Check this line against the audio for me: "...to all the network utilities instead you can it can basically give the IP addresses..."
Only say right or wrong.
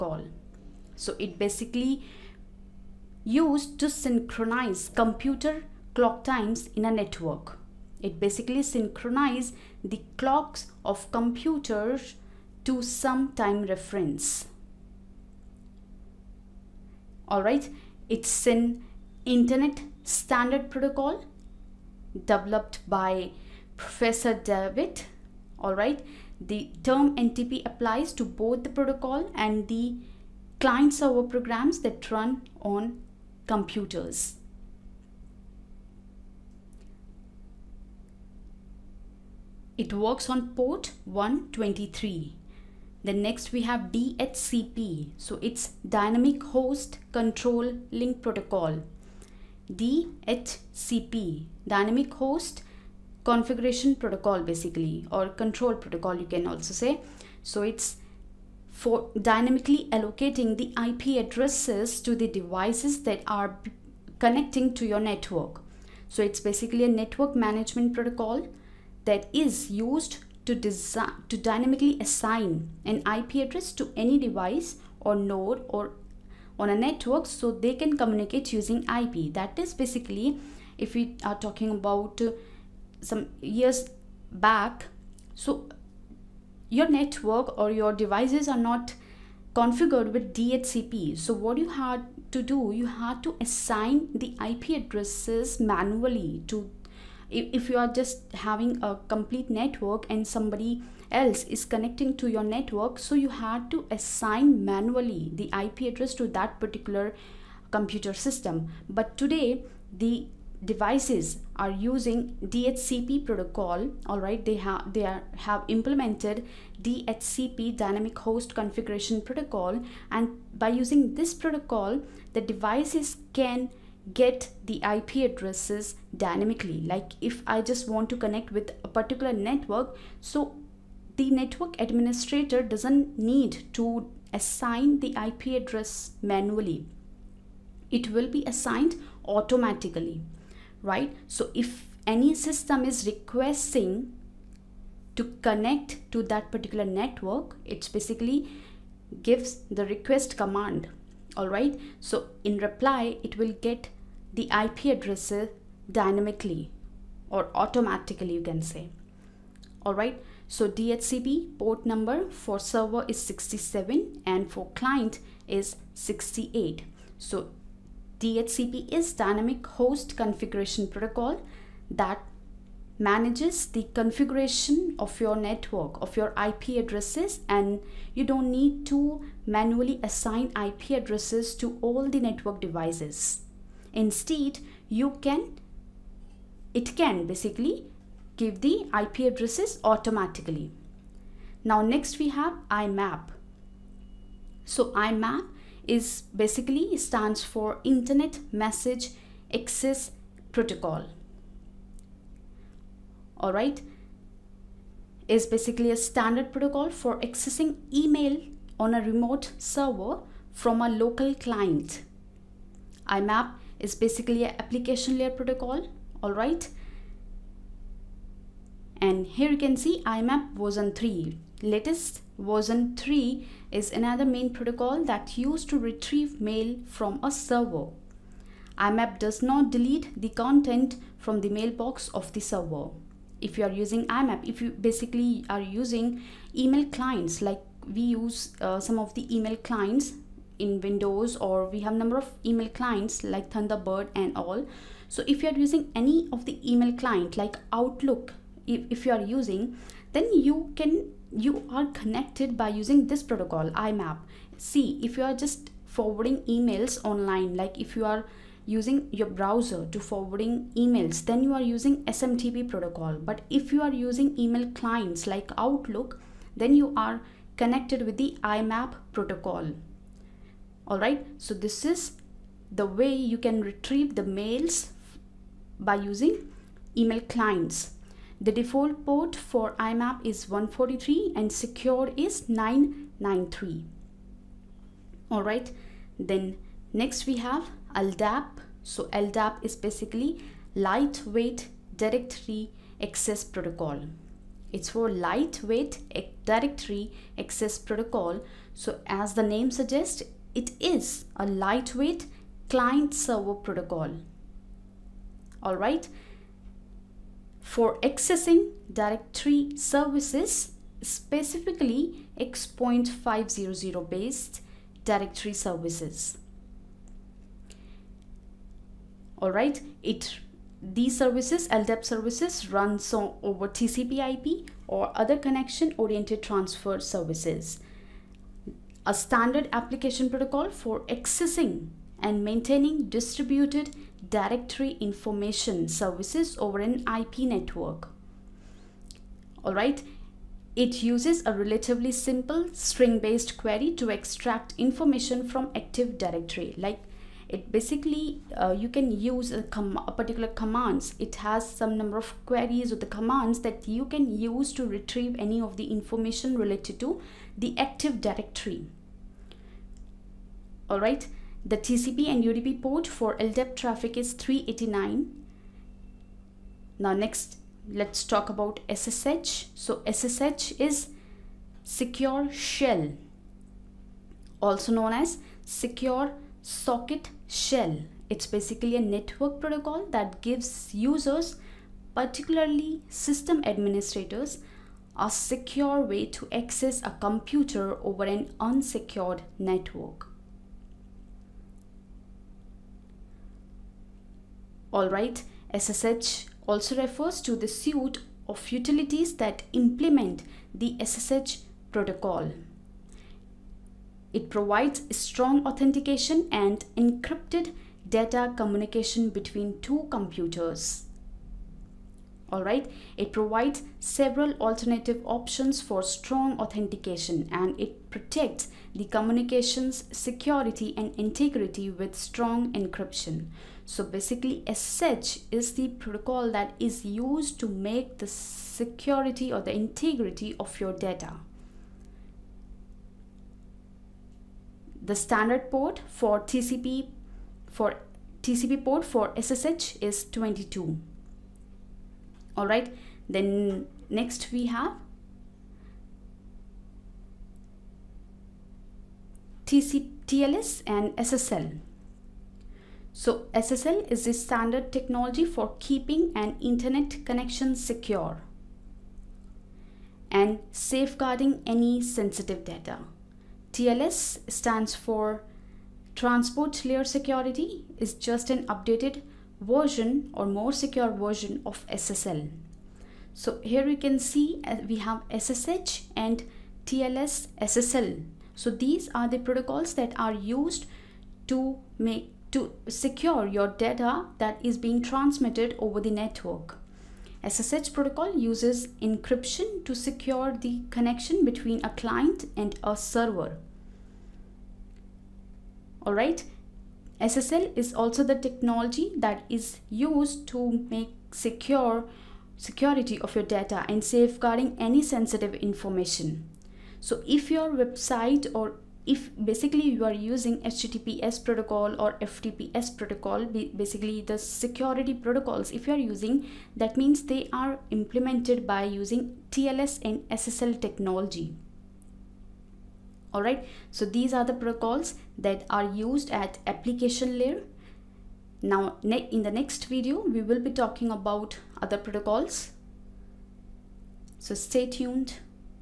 wrong.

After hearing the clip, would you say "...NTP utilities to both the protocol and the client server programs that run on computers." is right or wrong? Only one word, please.
wrong.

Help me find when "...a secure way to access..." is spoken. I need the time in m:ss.
6:25.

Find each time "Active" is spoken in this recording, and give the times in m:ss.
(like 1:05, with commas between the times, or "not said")
5:45, 5:57.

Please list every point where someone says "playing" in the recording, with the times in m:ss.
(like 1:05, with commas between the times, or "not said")
not said.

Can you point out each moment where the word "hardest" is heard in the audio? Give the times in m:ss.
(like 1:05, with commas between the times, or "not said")
not said.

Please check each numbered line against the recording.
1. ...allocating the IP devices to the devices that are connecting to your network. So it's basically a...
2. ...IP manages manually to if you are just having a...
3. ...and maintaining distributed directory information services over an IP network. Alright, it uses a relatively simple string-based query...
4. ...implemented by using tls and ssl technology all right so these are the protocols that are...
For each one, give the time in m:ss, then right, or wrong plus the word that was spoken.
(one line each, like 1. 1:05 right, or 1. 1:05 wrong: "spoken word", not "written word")
1. 0:59 wrong: "addresses", not "devices"
2. 1:34 wrong: "addresses", not "manages"
3. 5:32 right
4. 8:37 right.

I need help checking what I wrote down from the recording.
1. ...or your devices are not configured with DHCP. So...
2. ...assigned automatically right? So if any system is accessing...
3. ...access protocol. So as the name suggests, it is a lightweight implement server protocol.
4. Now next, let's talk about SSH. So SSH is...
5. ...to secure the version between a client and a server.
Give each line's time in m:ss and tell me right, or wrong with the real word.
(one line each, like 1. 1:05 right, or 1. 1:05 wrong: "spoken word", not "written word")
1. 1:27 right
2. 2:18 wrong: "requesting", not "accessing"
3. 4:57 wrong: "client", not "implement"
4. 6:06 right
5. 8:09 wrong: "connection", not "version".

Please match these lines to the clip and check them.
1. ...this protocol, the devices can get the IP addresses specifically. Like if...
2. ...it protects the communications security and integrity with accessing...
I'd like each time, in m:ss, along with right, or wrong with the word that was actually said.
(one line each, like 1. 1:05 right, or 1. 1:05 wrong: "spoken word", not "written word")
1. 2:01 wrong: "dynamically", not "specifically"
2. 6:57 wrong: "strong", not "accessing".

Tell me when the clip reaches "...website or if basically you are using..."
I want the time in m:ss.
8:27.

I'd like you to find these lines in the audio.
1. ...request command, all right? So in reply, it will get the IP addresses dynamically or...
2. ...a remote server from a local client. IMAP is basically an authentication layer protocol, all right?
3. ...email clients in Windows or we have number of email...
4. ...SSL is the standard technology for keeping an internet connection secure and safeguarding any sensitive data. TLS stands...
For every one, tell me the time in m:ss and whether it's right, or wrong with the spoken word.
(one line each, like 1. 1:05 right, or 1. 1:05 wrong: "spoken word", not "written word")
1. 2:29 right
2. 3:28 wrong: "application", not "authentication"
3. 3:59 right
4. 7:33 right.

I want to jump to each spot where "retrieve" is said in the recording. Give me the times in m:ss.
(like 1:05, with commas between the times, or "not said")
3:45, 4:33, 5:54.